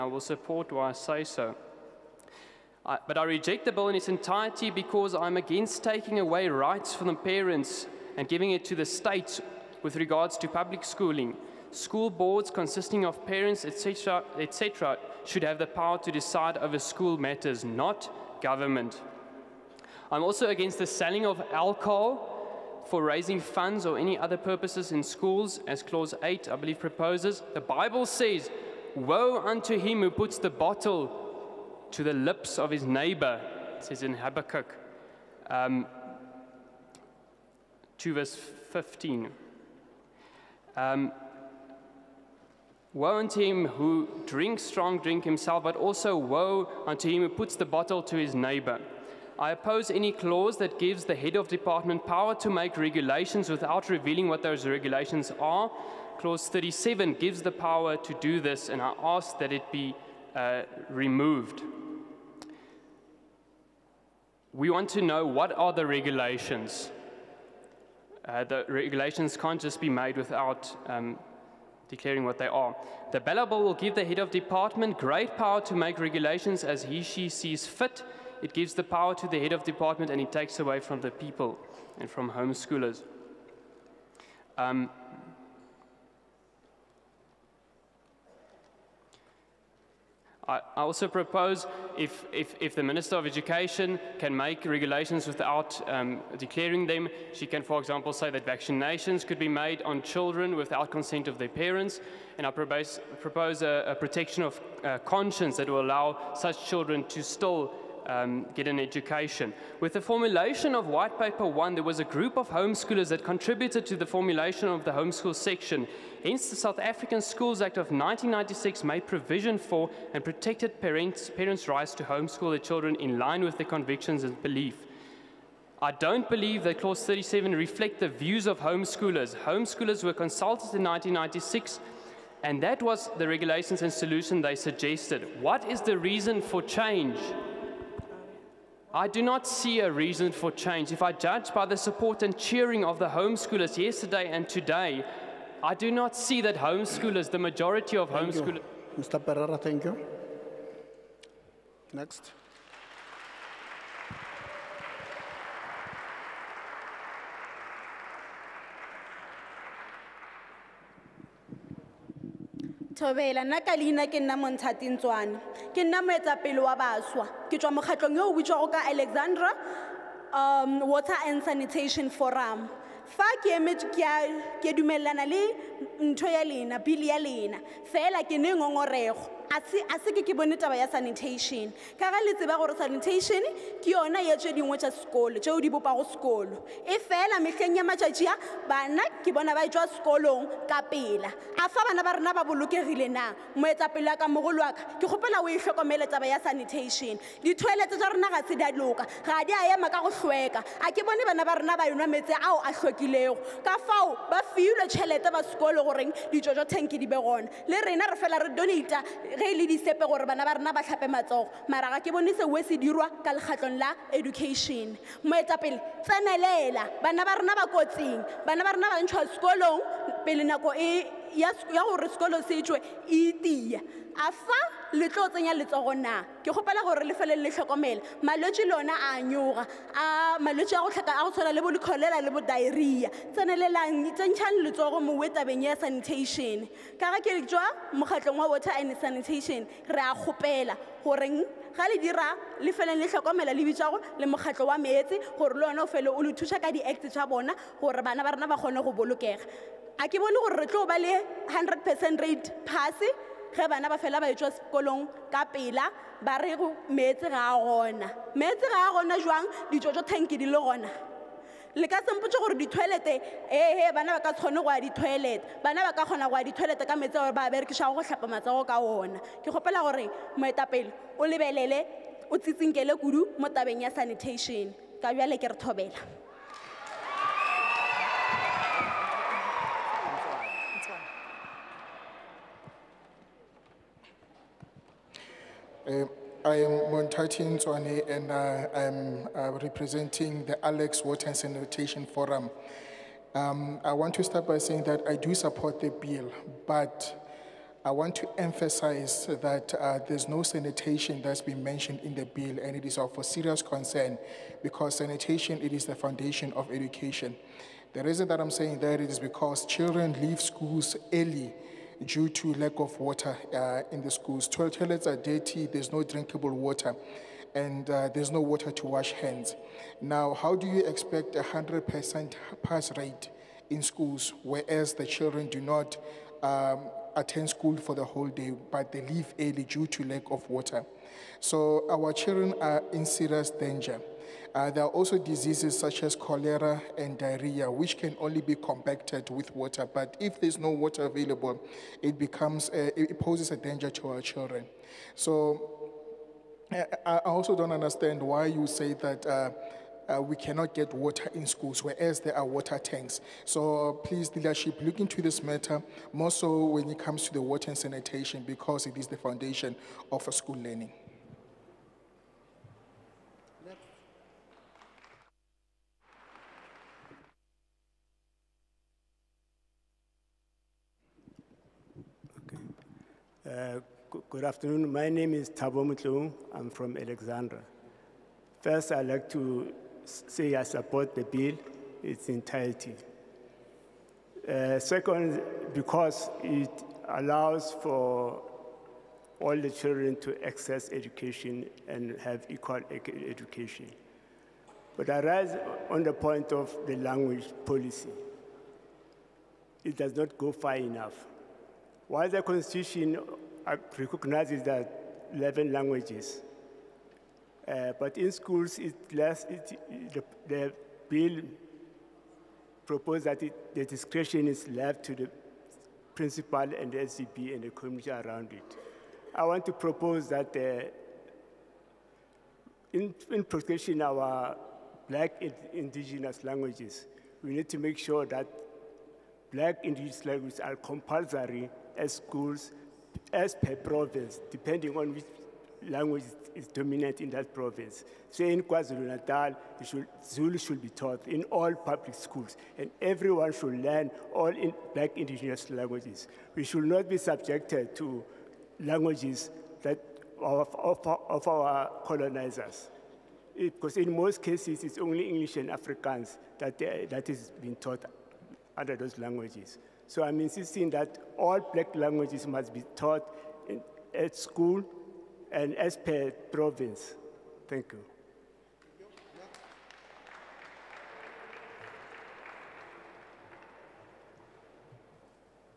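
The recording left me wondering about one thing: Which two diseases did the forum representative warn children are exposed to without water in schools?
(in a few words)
Cholera and diarrhea.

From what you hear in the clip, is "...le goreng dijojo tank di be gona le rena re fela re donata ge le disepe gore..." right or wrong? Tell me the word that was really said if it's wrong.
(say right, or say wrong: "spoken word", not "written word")
right.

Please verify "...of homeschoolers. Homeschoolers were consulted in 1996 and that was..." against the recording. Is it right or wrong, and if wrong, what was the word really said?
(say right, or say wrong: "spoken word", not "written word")
right.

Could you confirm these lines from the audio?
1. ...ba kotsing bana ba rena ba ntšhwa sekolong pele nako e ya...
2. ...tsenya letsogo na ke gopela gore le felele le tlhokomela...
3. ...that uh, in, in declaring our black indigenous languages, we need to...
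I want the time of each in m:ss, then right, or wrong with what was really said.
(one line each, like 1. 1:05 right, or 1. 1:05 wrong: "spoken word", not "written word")
1. 3:37 right
2. 3:45 right
3. 7:00 wrong: "protecting", not "declaring".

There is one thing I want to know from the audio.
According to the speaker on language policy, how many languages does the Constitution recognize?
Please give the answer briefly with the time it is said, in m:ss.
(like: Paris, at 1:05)
11, at 6:45.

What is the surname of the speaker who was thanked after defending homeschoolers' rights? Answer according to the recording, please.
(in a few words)
Pereira.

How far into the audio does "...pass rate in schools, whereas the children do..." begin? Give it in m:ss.
5:22.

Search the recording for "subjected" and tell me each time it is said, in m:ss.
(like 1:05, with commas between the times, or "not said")
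7:27.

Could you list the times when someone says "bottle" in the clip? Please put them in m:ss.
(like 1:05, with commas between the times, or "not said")
0:30, 0:47.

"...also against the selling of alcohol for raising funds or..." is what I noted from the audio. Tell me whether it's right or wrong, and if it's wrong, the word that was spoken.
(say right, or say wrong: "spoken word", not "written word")
right.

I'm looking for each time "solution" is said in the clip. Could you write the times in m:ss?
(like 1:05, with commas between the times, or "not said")
2:13.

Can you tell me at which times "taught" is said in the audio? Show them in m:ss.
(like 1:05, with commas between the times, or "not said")
7:20, 7:37, 7:42.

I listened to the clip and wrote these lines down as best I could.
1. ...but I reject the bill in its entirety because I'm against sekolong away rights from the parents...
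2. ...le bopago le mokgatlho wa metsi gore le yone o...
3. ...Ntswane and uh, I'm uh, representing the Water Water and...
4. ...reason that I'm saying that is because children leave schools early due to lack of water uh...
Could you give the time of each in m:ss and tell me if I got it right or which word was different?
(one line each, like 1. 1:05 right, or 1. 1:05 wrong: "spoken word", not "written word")
1. 0:03 wrong: "taking", not "sekolong"
2. 4:03 wrong: "bitswago", not "bopago"
3. 4:47 wrong: "Alex", not "Water"
4. 5:08 right.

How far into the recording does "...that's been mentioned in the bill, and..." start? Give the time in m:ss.
5:01.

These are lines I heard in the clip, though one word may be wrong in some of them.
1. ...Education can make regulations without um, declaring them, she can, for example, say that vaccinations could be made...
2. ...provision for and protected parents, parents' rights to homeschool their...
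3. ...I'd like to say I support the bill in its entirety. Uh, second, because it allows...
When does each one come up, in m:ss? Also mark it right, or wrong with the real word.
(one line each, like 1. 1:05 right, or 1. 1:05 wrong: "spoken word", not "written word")
1. 1:33 right
2. 1:59 right
3. 6:18 right.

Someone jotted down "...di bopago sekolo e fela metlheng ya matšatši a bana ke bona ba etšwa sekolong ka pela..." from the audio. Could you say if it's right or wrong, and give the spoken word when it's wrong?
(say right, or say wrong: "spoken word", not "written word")
right.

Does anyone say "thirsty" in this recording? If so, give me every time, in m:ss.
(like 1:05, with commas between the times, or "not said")
not said.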